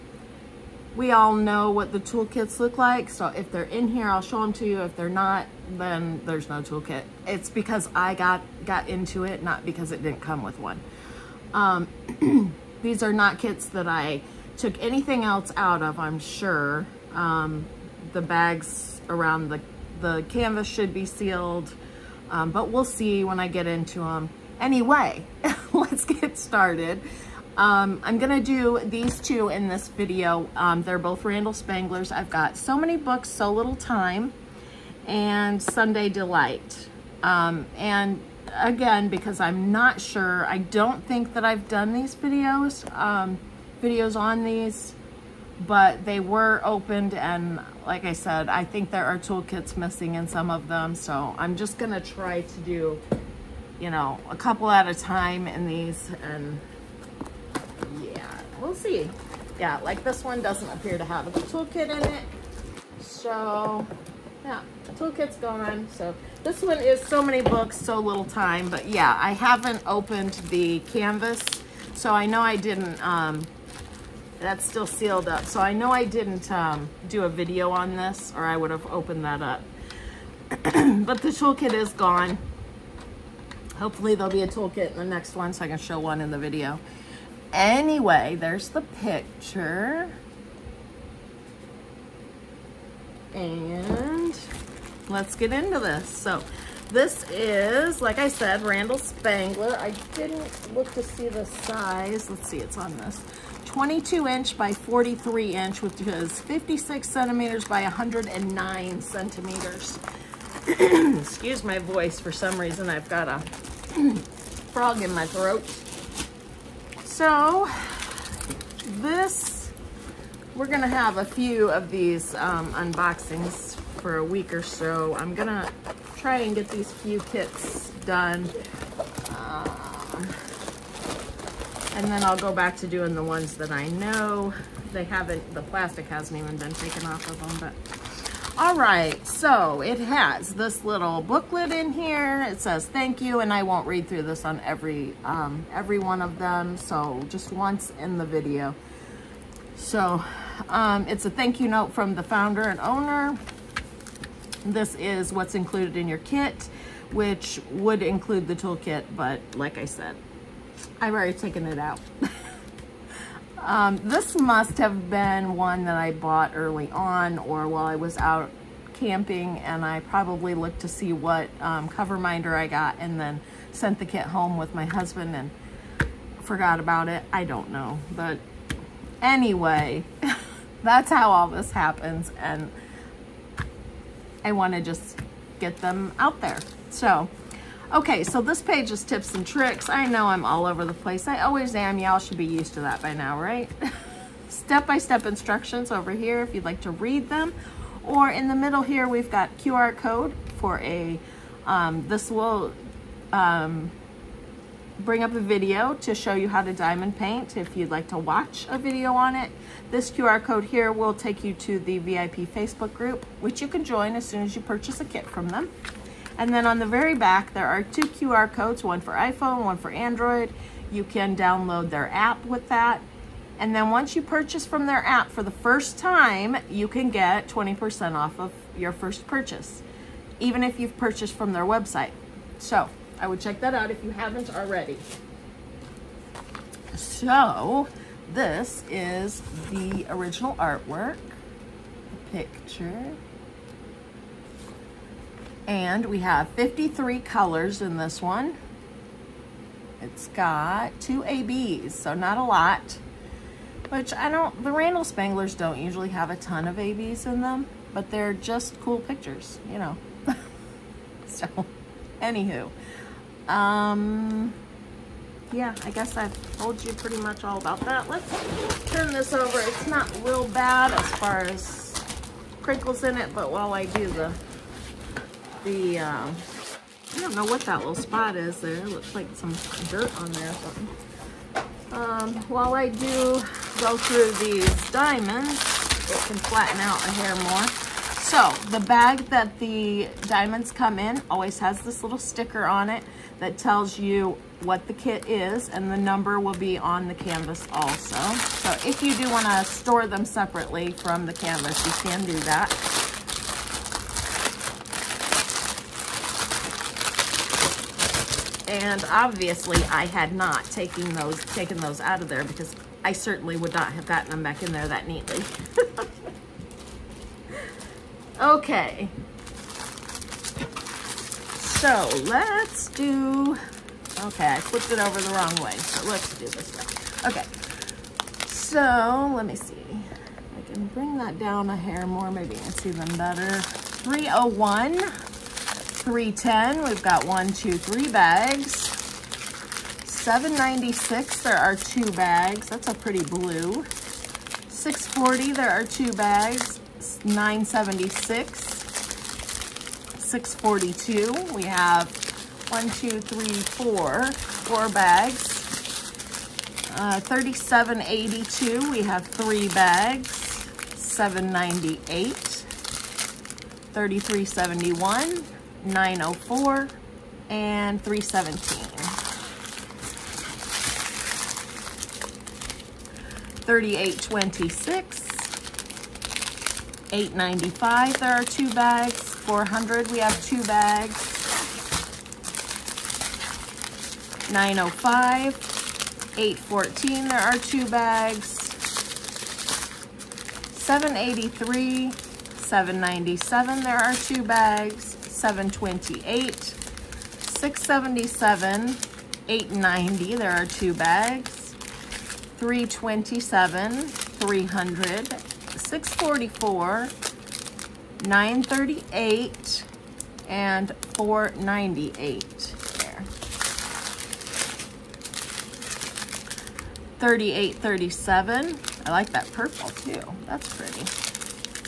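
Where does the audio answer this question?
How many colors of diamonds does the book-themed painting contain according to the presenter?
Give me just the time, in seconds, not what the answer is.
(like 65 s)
246 s.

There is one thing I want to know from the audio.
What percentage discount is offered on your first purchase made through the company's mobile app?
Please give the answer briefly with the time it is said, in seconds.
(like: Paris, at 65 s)
20%, at 227 s.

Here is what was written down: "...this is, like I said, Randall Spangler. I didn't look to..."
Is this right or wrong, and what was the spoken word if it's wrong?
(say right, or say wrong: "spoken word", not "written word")
right.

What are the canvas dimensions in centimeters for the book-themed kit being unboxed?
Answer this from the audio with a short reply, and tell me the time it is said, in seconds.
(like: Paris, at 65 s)
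56 by 109 centimeters, at 106 s.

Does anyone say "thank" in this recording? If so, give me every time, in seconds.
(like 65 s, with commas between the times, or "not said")
142 s, 151 s.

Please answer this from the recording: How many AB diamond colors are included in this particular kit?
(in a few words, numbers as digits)
2.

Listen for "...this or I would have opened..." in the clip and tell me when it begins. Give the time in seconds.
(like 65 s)
77 s.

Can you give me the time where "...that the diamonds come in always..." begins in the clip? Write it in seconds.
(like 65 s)
289 s.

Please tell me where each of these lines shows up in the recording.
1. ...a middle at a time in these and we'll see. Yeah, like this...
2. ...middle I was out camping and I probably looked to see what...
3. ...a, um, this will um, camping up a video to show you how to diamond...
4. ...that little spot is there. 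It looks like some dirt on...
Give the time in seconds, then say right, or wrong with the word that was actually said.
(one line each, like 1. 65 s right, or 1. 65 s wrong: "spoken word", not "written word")
1. 54 s wrong: "couple", not "middle"
2. 167 s wrong: "while", not "middle"
3. 200 s wrong: "bring", not "camping"
4. 277 s right.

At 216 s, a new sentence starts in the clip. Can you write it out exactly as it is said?
And then on the very back, there are two QR codes, one for iPhone, one for Android.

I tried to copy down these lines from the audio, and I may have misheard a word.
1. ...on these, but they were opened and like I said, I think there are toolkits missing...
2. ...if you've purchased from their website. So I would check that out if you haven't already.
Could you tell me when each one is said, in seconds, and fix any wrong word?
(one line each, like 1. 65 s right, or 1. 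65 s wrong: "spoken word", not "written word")
1. 44 s right
2. 230 s right.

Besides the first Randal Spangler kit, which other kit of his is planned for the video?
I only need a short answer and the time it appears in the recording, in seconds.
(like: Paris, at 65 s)
Sunday Delight, at 35 s.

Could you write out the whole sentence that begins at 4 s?
If they're not, then there's no toolkit.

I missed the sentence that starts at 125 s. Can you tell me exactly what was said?
I'm gonna try and get these few kits done.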